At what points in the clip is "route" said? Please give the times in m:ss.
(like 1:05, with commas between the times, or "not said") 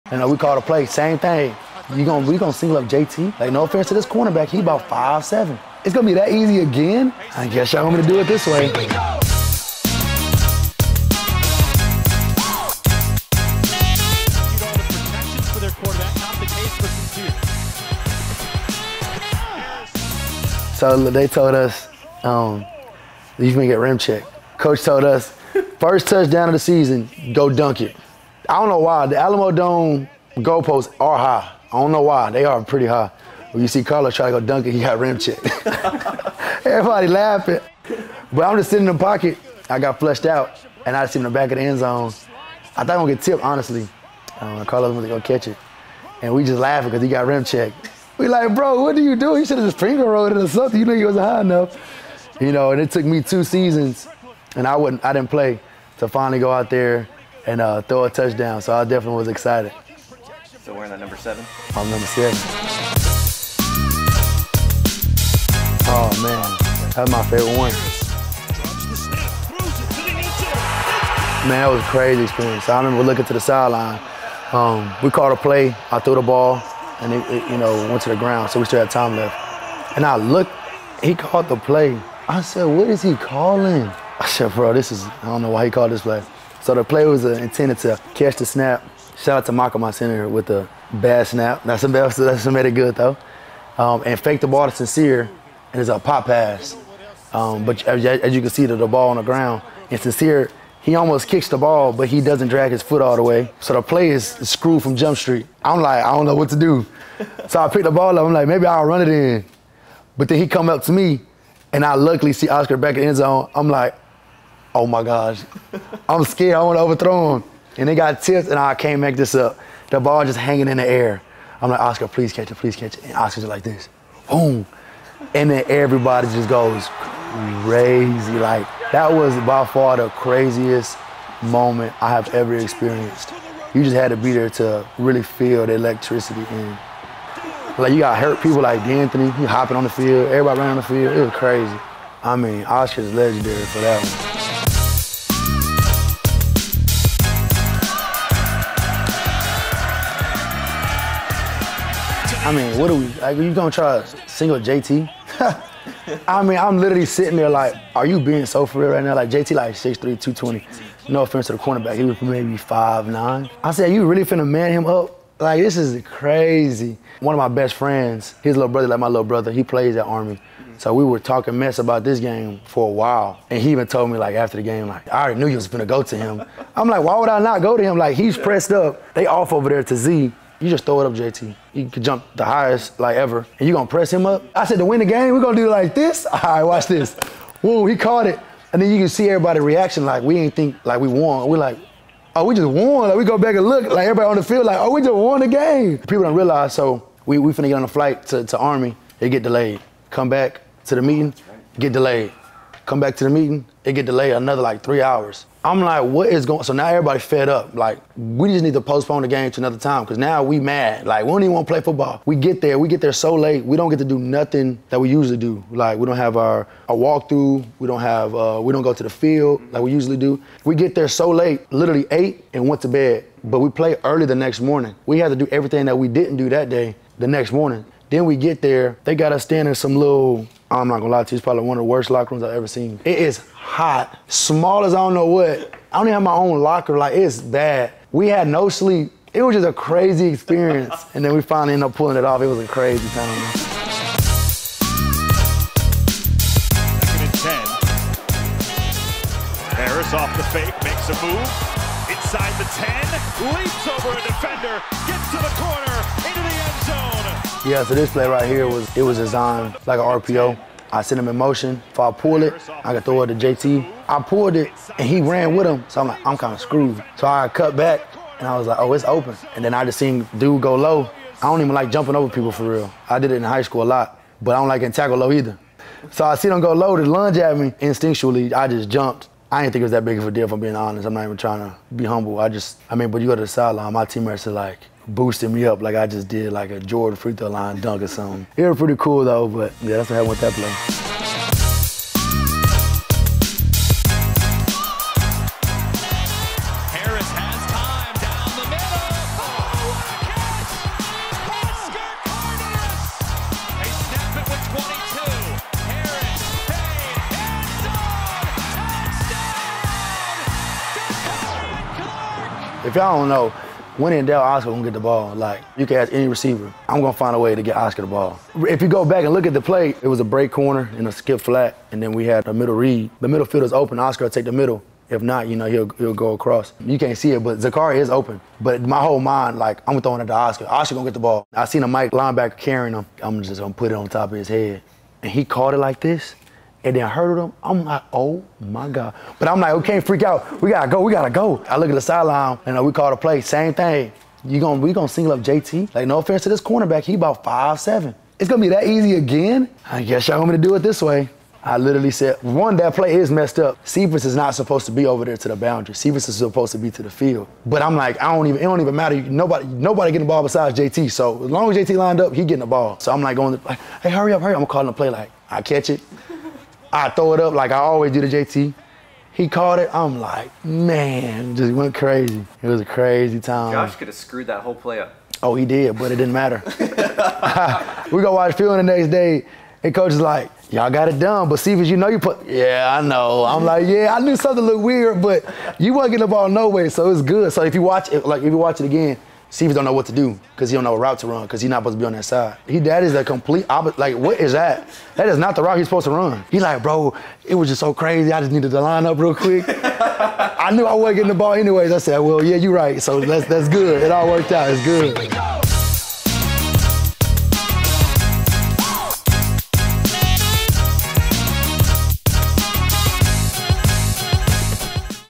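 6:30, 6:35.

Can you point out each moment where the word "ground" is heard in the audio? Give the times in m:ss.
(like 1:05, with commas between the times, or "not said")
1:18, 1:39.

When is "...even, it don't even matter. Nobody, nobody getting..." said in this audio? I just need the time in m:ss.
5:58.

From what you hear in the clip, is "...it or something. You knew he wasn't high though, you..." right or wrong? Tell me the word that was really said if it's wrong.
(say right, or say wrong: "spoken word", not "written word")
wrong: "enough", not "though".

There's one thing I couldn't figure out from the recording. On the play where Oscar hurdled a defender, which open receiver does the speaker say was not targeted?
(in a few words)
Zakhari.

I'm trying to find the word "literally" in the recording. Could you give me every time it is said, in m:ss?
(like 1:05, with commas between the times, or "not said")
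2:36, 3:41, 5:51.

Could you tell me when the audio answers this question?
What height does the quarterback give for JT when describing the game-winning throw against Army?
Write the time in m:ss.
2:39.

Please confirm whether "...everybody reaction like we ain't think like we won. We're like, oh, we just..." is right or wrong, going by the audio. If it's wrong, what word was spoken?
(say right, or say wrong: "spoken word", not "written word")
right.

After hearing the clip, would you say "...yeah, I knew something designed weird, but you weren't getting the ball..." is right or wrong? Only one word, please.
wrong.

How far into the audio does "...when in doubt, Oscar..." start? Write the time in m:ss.
5:13.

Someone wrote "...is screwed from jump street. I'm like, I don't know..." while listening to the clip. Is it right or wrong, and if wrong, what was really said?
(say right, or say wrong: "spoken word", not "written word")
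right.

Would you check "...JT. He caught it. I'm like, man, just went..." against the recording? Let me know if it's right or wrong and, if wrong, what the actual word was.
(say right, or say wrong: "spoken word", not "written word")
right.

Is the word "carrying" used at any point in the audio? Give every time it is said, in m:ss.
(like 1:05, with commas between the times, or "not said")
5:32.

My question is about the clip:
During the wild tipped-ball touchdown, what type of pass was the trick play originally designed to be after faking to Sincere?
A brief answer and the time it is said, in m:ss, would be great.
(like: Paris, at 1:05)
pop pass, at 1:35.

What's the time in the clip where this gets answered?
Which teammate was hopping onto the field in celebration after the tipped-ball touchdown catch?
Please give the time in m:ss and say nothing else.
2:18.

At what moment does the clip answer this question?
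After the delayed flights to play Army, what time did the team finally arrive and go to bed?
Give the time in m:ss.
3:42.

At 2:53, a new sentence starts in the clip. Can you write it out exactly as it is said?
And he even told me like after the game, like, I already knew you was gonna go to him.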